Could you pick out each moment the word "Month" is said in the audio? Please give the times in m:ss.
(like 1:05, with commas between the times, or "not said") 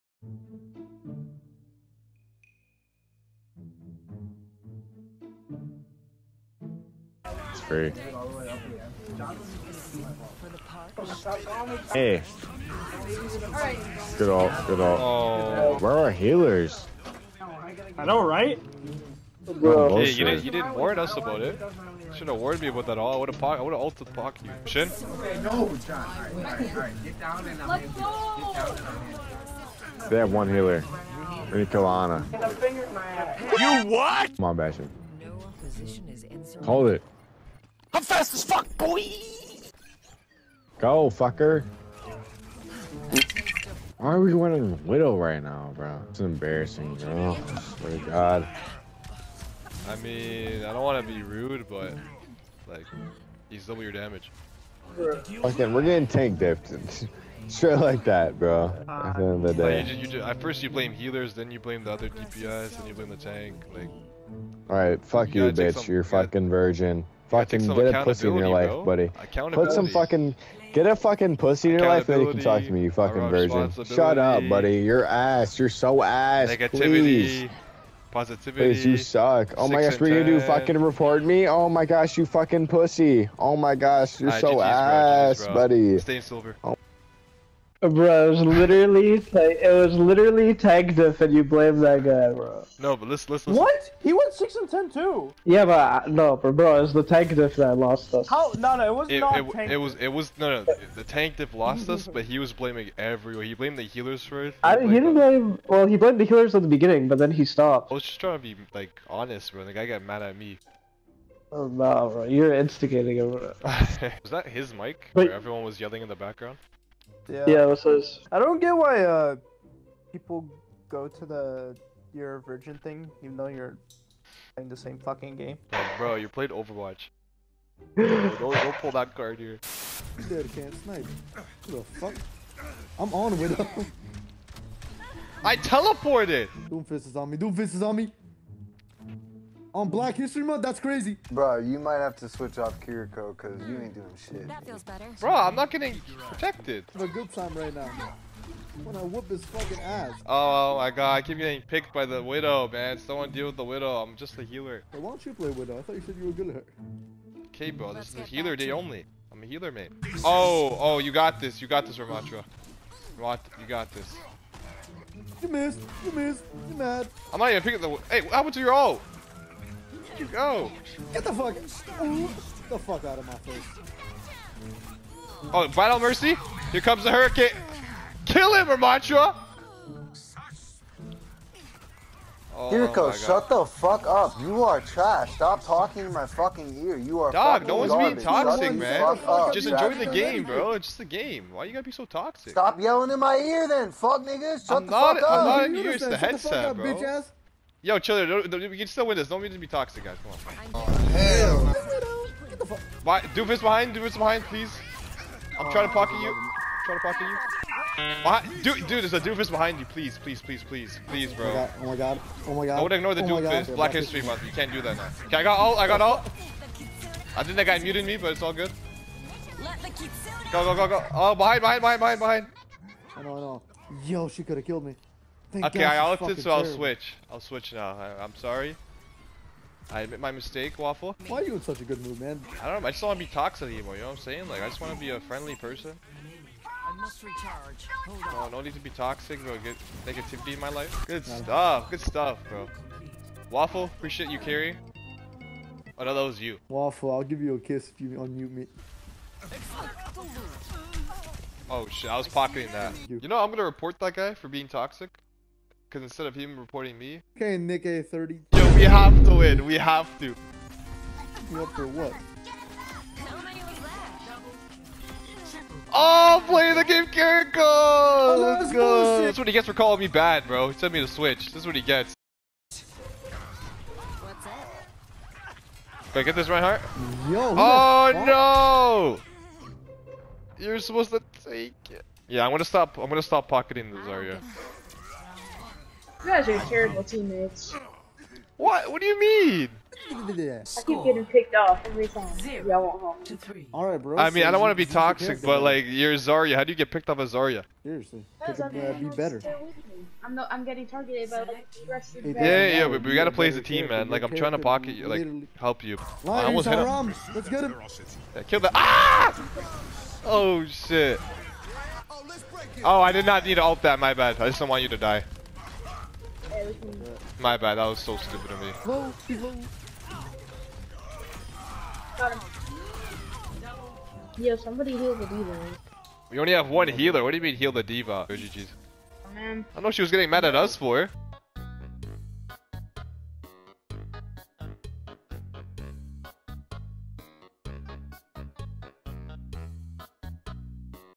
2:20, 3:34.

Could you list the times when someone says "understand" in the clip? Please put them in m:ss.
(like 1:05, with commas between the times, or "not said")
not said.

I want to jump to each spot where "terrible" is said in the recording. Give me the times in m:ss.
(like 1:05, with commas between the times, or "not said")
3:46, 4:46.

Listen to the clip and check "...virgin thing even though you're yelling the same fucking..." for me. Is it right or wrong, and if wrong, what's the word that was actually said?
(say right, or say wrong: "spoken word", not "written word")
wrong: "playing", not "yelling".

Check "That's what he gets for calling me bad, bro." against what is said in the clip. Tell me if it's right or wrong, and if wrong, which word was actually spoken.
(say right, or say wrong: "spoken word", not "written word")
right.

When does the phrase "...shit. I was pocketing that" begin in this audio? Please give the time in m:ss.
4:11.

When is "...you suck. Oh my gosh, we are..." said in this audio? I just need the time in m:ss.
1:18.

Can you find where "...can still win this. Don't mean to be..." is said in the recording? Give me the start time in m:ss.
3:18.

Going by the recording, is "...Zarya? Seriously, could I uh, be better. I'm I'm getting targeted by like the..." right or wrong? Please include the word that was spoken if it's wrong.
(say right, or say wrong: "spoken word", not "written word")
right.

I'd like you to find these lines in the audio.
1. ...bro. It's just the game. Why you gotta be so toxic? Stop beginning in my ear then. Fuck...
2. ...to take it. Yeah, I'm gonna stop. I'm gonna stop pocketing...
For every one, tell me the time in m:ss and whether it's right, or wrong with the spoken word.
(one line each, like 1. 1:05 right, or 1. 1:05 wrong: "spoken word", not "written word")
1. 3:10 wrong: "yelling", not "beginning"
2. 4:41 right.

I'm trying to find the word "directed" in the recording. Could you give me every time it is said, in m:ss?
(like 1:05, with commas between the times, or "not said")
not said.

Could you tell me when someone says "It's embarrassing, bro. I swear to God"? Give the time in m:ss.
0:46.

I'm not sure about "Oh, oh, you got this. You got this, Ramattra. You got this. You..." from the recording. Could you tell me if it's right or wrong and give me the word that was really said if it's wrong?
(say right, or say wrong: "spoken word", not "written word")
right.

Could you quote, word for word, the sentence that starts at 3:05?
Stop talking in my fucking ear.